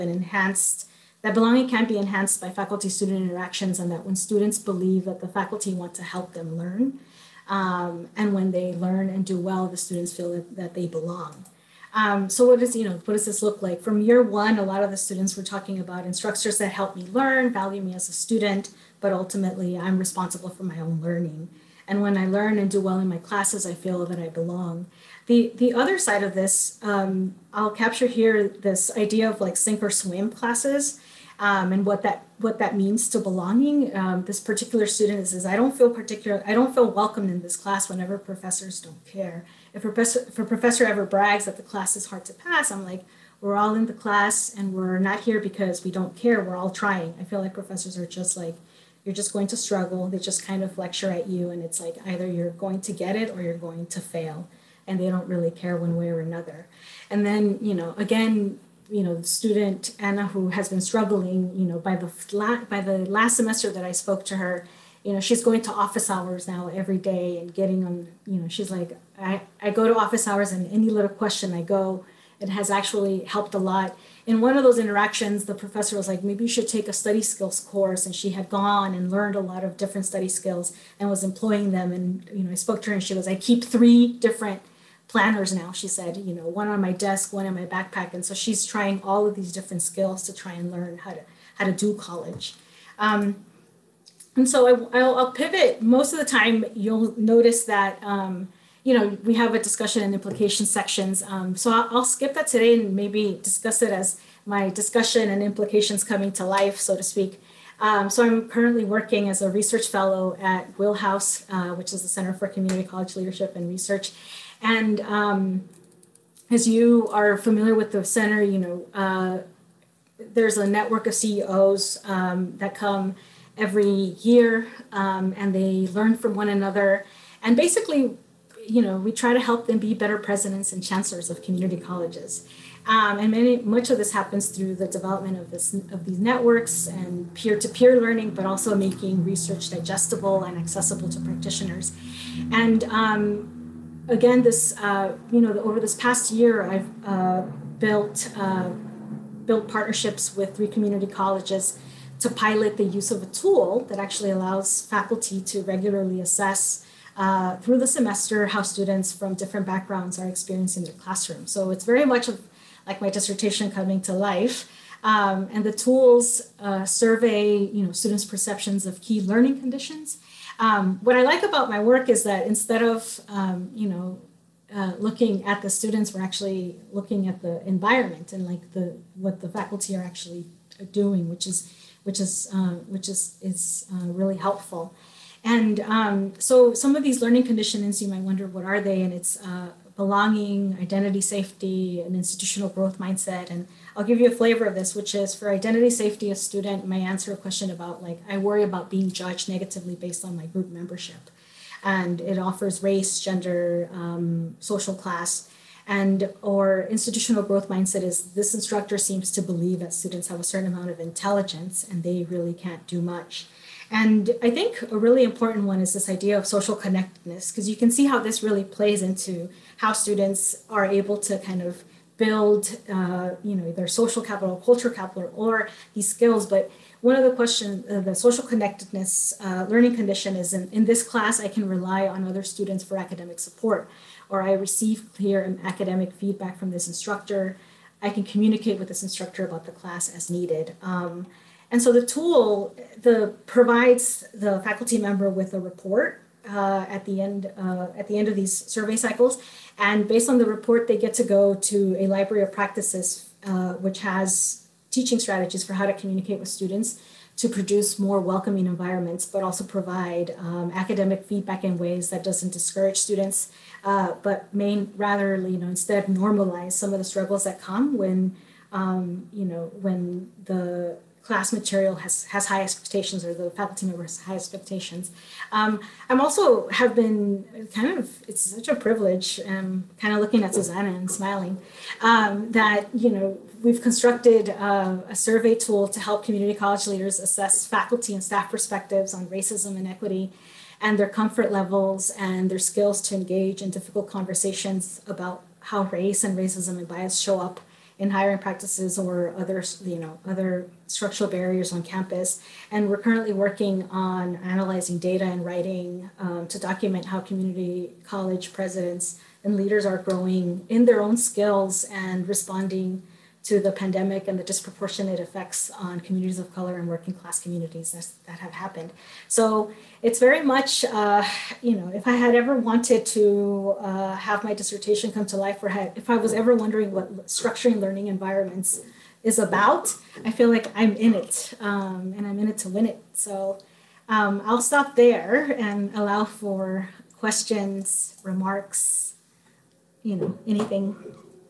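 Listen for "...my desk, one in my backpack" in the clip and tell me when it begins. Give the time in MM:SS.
01:26.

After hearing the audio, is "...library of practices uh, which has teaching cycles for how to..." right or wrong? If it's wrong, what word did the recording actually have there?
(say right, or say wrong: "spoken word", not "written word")
wrong: "strategies", not "cycles".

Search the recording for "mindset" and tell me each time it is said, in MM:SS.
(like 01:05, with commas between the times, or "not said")
03:12, 03:27.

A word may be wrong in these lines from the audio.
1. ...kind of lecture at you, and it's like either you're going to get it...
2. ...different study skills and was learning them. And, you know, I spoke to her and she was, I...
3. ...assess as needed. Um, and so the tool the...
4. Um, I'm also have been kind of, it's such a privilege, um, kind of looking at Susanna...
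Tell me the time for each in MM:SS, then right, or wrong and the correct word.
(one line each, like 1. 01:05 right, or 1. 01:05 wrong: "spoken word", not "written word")
1. 00:50 right
2. 01:19 wrong: "employing", not "learning"
3. 03:59 wrong: "class", not "assess"
4. 04:35 right.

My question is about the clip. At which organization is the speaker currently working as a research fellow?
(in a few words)
Wheelhouse.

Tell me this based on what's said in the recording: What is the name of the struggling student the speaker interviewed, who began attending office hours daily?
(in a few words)
Anna.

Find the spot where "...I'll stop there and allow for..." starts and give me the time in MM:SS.
05:34.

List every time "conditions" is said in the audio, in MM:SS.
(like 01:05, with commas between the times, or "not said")
02:49, 03:07, 03:49.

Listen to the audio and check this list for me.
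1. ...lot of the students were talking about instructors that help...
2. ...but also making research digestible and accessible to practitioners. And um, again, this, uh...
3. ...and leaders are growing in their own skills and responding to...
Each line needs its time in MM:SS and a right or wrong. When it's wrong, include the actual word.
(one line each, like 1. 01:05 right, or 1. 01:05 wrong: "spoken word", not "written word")
1. 00:14 right
2. 02:18 right
3. 05:09 right.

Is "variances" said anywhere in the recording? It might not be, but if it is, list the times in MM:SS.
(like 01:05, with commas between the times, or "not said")
not said.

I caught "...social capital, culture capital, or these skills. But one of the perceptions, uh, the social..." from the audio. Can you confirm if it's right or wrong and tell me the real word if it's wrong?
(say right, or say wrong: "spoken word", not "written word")
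wrong: "questions", not "perceptions".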